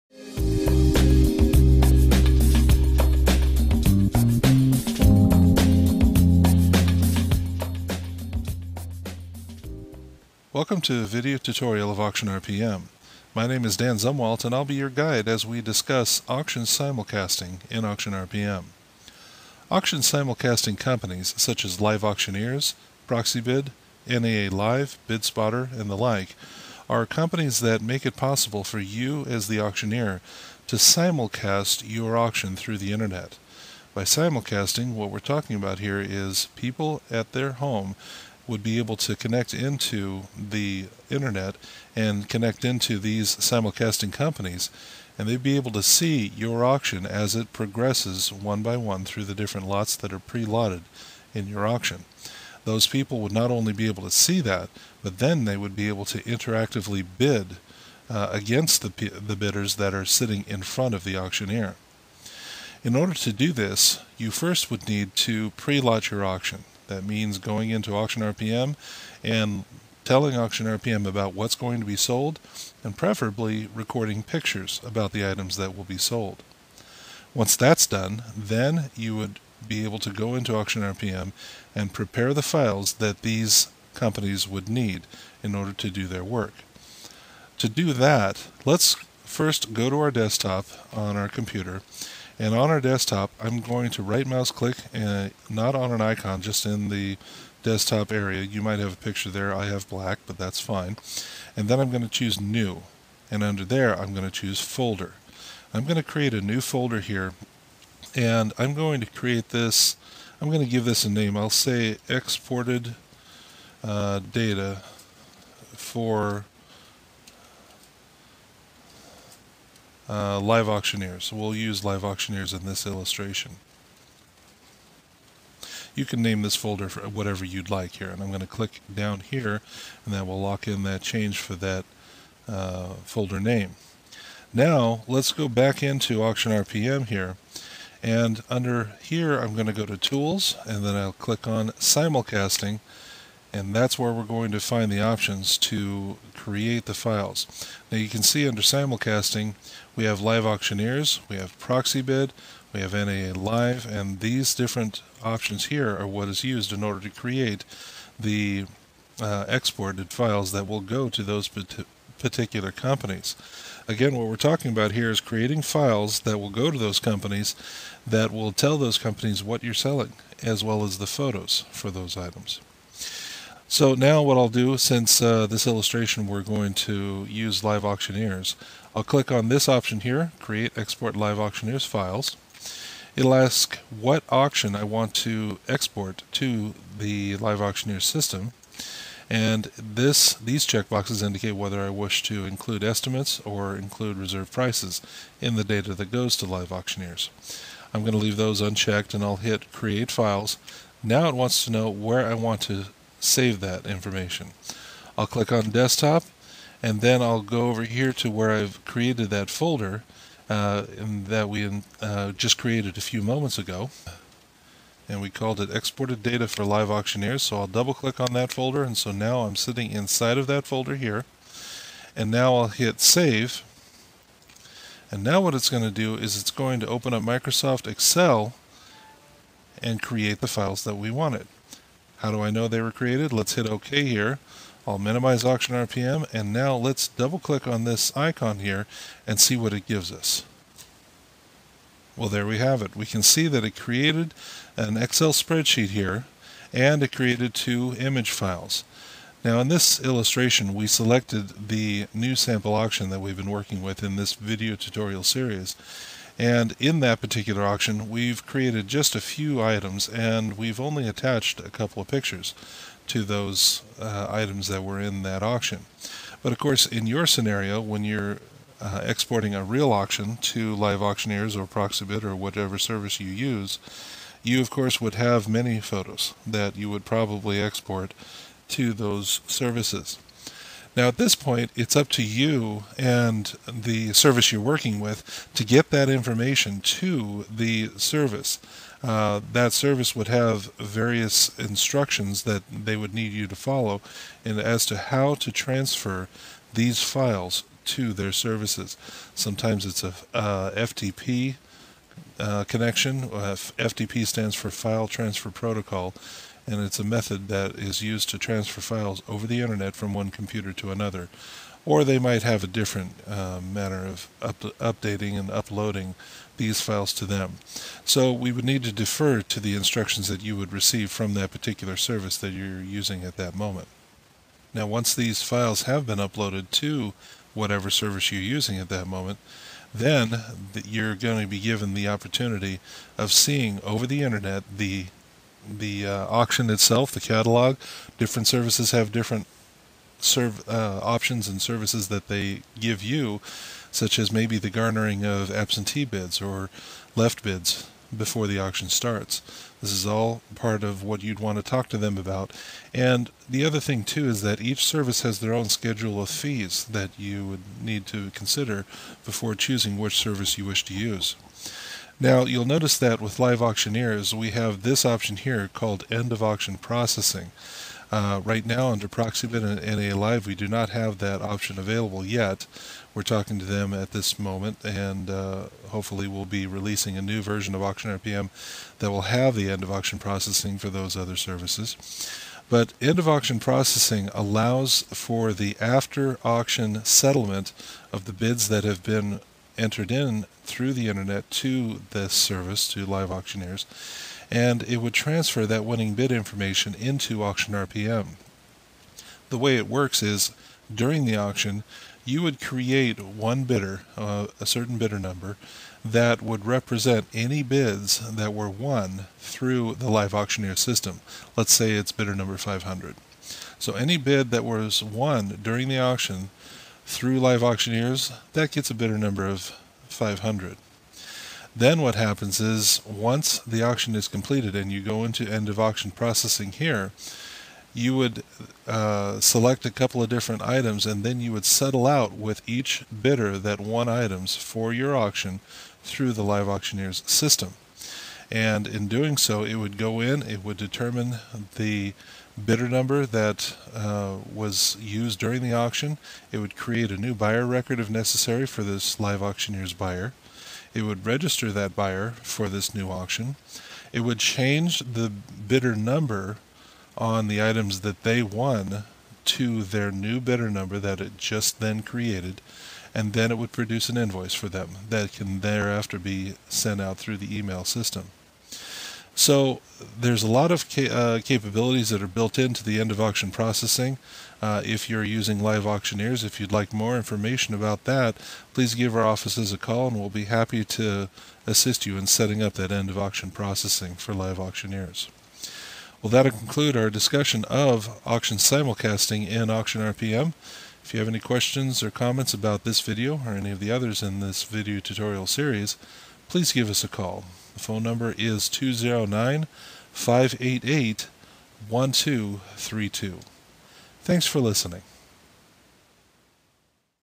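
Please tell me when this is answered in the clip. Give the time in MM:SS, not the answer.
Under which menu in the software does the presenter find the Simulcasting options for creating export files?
02:19.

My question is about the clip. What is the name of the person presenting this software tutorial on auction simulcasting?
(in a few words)
Dan Zumwalt.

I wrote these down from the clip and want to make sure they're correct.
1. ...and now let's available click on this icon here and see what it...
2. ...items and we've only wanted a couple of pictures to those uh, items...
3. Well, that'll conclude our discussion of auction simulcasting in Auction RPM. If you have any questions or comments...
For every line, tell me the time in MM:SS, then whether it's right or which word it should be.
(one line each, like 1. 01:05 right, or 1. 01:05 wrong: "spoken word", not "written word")
1. 03:56 wrong: "double", not "available"
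2. 04:19 wrong: "attached", not "wanted"
3. 08:06 right.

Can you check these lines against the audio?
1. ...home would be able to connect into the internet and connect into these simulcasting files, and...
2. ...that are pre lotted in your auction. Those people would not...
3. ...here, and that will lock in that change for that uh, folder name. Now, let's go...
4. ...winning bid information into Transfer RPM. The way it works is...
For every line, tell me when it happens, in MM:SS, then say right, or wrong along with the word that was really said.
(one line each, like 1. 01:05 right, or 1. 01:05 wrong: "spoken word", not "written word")
1. 00:37 wrong: "companies", not "files"
2. 00:49 right
3. 02:09 right
4. 06:35 wrong: "Auction", not "Transfer".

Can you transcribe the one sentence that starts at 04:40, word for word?
Now, at this point, it's up to you and the service you're working with to get that information to the service.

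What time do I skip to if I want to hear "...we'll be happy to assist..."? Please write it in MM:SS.
08:00.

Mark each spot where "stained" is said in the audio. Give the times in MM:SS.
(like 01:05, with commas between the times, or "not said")
not said.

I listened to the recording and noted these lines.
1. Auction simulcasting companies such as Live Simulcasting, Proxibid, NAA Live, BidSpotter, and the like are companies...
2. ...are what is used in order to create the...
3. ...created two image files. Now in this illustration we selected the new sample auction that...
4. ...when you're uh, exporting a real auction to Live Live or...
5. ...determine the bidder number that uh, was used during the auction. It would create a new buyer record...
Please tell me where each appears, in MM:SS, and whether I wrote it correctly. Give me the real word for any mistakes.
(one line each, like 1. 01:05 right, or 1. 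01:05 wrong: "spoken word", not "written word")
1. 00:19 wrong: "Auctioneers", not "Simulcasting"
2. 02:35 right
3. 04:07 right
4. 04:27 wrong: "Auctioneers", not "Live"
5. 07:20 right.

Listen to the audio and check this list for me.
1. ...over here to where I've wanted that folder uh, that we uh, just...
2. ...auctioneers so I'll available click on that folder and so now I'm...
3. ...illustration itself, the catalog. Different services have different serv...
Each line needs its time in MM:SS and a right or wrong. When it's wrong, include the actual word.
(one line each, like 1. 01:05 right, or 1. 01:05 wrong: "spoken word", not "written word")
1. 03:27 wrong: "created", not "wanted"
2. 03:36 wrong: "double", not "available"
3. 05:36 wrong: "auction", not "illustration".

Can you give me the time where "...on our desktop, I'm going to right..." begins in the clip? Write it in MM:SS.
01:32.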